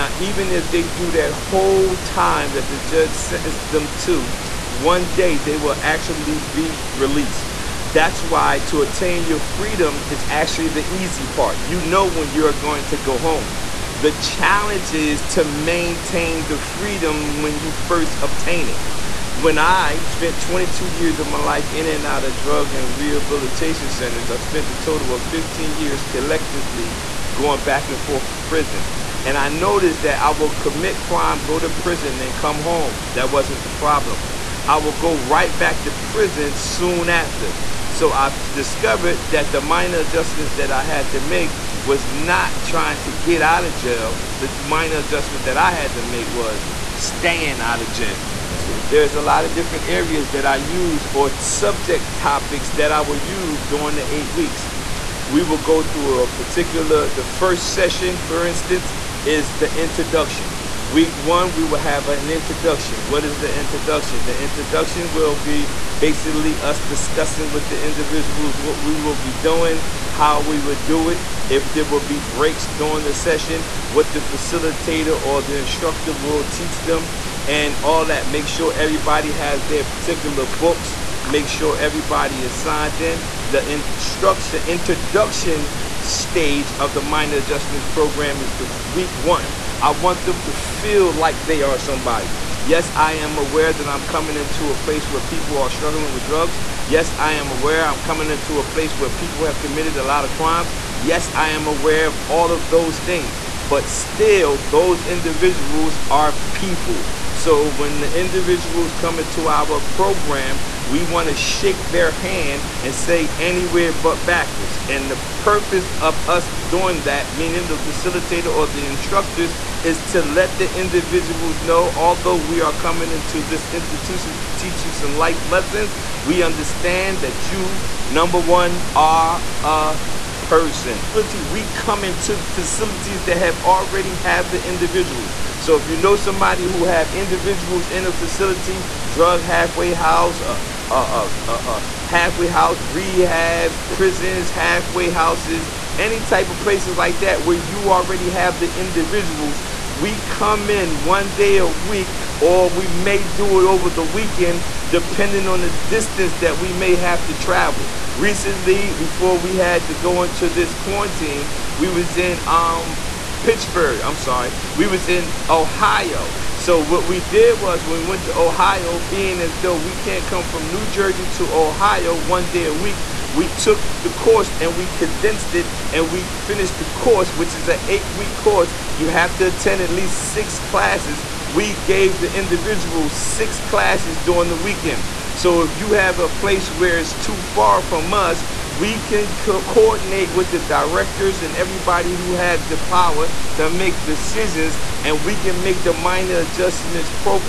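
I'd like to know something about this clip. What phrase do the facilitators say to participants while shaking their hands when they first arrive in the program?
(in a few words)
anywhere but backwards.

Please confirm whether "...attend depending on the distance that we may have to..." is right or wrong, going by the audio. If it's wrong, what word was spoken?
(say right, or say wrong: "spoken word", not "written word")
wrong: "weekend", not "attend".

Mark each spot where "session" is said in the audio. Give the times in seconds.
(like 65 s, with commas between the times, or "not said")
57 s, 73 s.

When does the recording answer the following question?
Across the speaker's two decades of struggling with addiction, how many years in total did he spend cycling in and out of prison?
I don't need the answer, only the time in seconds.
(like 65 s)
25 s.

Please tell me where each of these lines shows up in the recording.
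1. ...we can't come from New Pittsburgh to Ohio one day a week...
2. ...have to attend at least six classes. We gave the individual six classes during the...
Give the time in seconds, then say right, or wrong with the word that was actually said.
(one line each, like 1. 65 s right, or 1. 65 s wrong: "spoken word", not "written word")
1. 169 s wrong: "Jersey", not "Pittsburgh"
2. 179 s right.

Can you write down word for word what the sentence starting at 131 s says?
We come into facilities that have already have the individuals.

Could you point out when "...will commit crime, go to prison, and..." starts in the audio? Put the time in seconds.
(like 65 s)
30 s.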